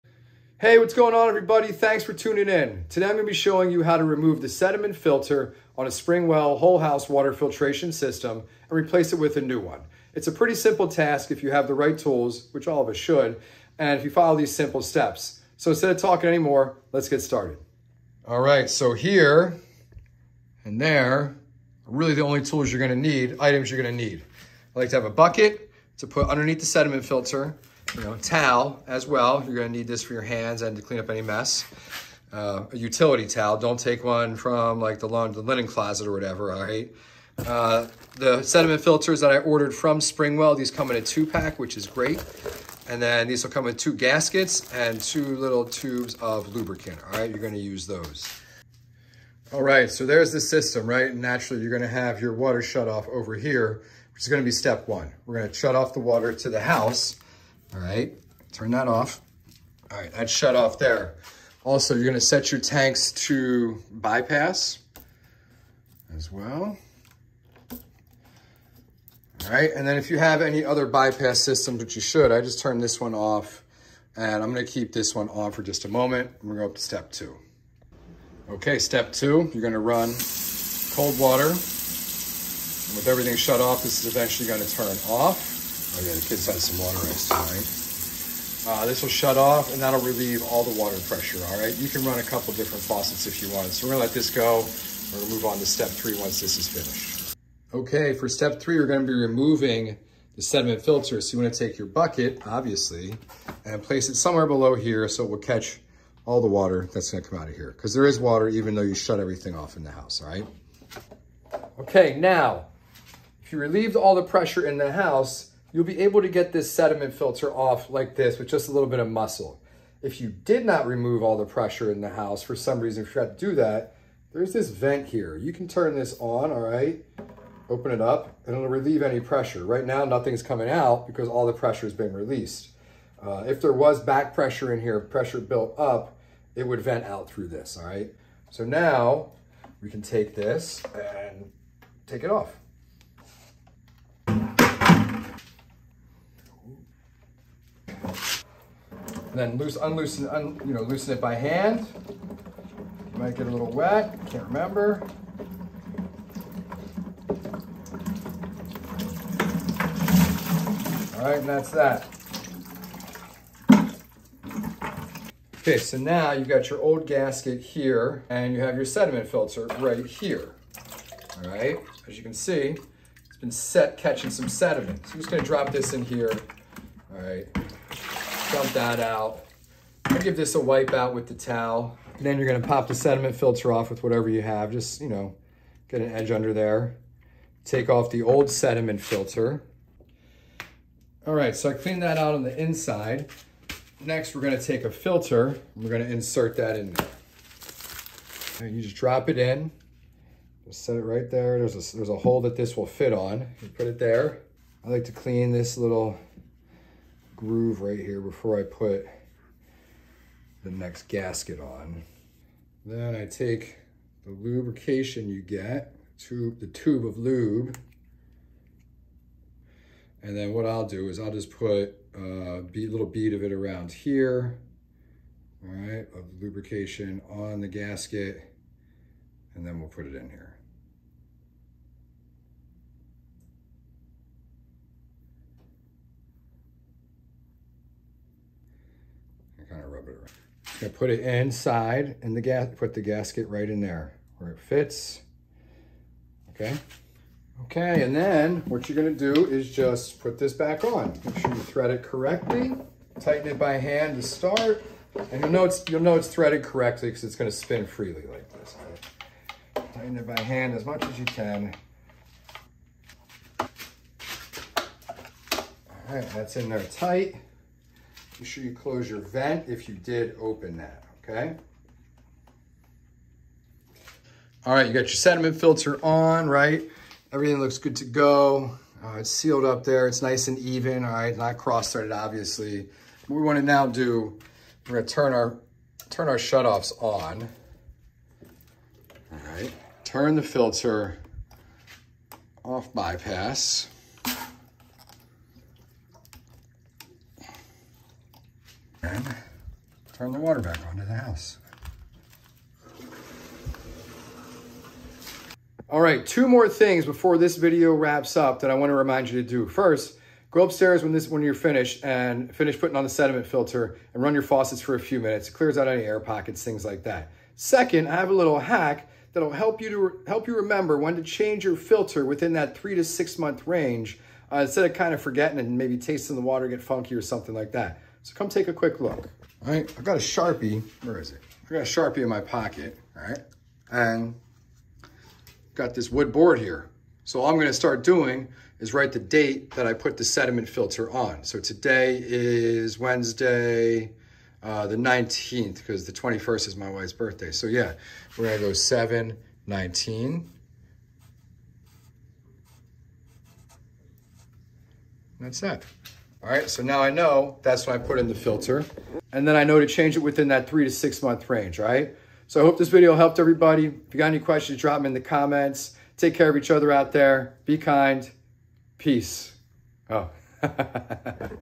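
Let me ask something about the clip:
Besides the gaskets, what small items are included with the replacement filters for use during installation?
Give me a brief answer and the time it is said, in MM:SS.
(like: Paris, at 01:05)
tubes of lubricant, at 00:44.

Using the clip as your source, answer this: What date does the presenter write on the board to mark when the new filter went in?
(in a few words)
7/19.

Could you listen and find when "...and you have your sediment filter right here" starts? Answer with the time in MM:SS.
02:48.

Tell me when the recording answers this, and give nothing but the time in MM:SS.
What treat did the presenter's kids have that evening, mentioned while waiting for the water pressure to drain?
01:26.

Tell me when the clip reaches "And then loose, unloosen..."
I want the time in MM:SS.
02:29.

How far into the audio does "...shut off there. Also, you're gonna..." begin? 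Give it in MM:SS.
01:00.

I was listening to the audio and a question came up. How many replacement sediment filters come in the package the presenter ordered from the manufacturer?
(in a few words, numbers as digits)
2.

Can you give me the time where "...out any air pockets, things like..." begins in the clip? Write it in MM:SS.
05:15.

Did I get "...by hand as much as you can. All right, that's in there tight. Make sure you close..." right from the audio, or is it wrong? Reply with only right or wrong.
right.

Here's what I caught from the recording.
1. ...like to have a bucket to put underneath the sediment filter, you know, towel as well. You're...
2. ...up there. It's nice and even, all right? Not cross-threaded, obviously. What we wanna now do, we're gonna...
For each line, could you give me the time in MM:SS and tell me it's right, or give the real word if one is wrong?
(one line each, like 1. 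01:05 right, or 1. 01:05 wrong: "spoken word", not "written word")
1. 00:24 right
2. 04:39 right.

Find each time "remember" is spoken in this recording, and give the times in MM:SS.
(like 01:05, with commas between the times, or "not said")
02:34, 05:20.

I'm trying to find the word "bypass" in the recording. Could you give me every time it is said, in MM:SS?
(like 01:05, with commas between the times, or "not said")
01:03, 01:10, 04:52.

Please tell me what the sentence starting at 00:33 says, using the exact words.
Don't take one from like the, lawn, the linen closet or whatever, all right?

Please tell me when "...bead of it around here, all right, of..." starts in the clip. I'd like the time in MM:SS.
03:43.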